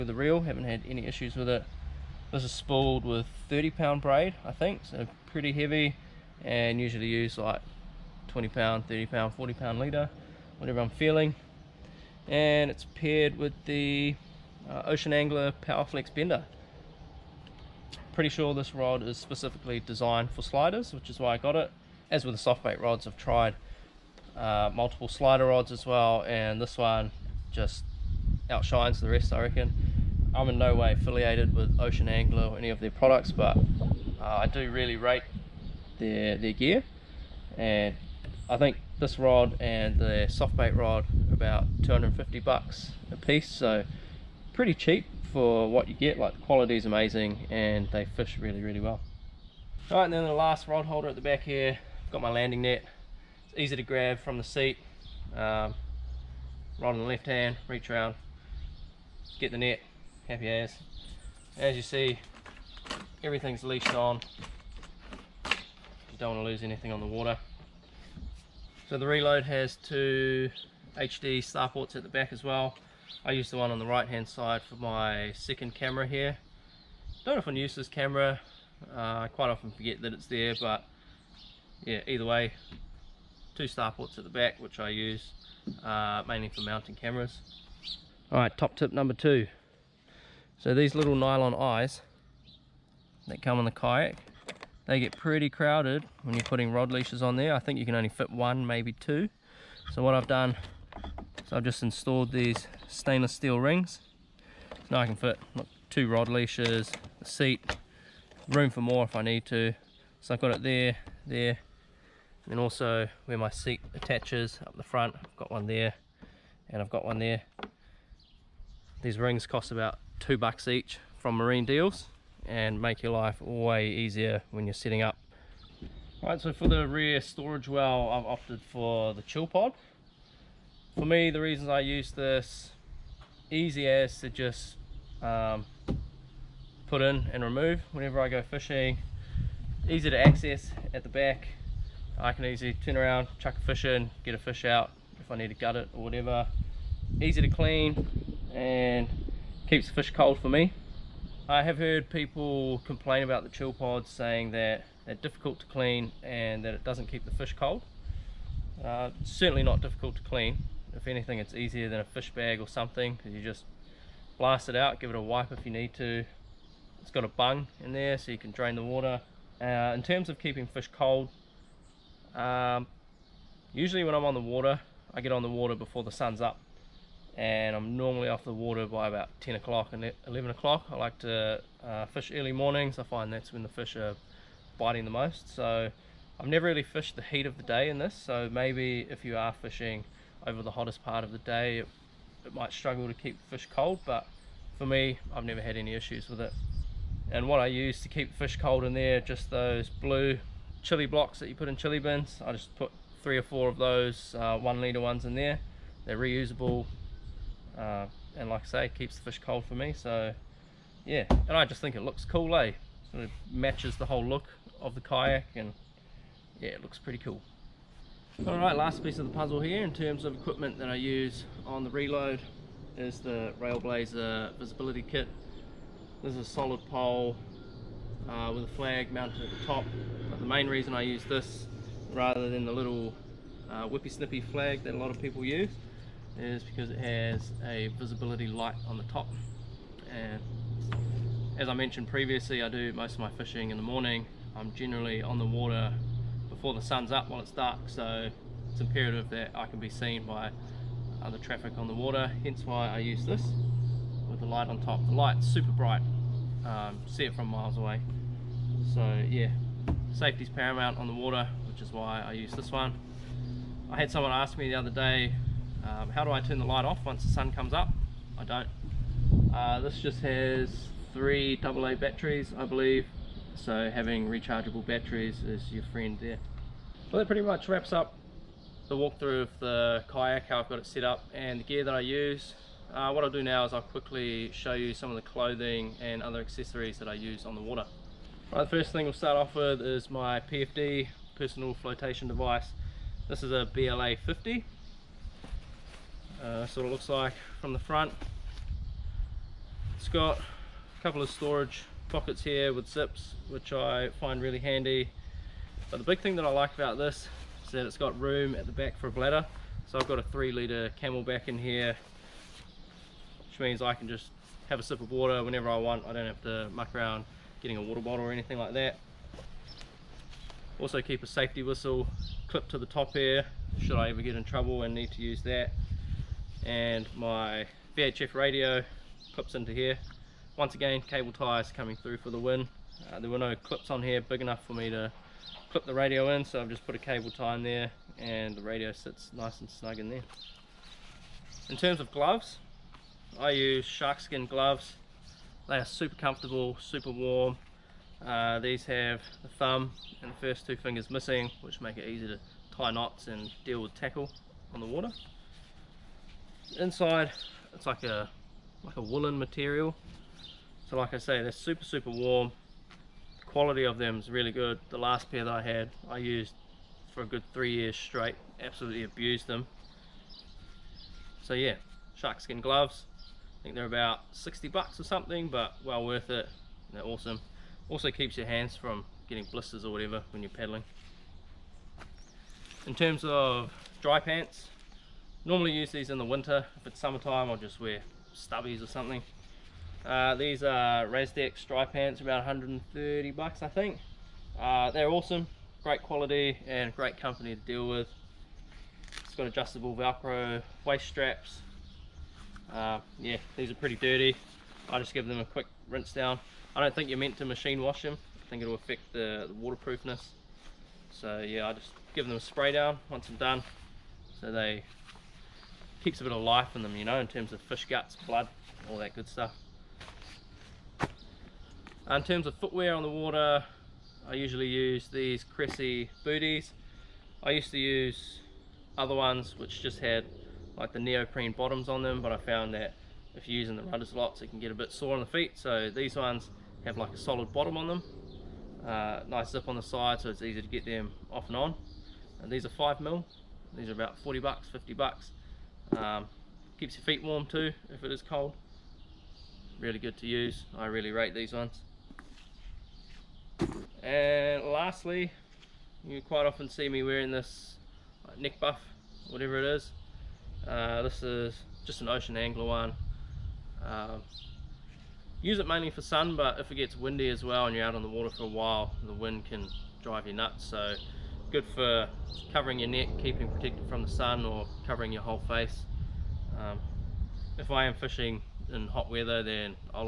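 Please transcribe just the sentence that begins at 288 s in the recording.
Right, the first thing we'll start off with is my PFD, personal flotation device.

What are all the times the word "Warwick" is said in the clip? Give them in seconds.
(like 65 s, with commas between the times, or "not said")
not said.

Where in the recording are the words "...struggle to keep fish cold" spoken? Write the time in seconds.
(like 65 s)
192 s.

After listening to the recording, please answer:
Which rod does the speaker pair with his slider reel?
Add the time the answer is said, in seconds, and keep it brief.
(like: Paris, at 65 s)
Ocean Angler Powerflex Bender, at 14 s.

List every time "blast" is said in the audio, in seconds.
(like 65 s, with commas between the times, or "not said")
164 s.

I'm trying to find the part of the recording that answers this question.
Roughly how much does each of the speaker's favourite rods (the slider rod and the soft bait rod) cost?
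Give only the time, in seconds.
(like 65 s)
41 s.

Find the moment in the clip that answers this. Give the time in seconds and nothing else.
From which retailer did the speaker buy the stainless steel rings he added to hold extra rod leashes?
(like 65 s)
121 s.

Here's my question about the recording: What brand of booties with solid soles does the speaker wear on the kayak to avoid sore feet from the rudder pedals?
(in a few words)
Cressi.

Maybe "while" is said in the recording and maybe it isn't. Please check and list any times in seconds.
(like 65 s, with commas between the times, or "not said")
247 s, 468 s.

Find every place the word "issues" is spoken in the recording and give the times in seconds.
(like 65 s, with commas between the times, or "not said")
1 s, 195 s.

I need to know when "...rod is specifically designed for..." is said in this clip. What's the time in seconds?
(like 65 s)
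18 s.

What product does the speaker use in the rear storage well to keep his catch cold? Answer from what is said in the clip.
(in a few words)
Chill pod.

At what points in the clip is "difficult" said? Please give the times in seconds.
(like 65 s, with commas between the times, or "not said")
155 s, 159 s.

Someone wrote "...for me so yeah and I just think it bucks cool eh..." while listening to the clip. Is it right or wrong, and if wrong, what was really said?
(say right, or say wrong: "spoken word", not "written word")
wrong: "looks", not "bucks".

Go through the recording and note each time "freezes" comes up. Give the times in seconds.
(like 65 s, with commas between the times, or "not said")
not said.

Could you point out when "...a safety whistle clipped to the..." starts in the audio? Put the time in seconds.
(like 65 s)
321 s.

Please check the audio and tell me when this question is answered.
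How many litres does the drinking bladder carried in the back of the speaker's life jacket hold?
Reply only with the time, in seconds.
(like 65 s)
310 s.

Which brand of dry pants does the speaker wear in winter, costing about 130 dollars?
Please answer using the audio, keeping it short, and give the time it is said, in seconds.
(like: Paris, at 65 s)
Rasdex, at 391 s.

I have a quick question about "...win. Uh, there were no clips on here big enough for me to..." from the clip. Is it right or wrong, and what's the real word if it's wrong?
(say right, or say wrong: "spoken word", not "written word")
right.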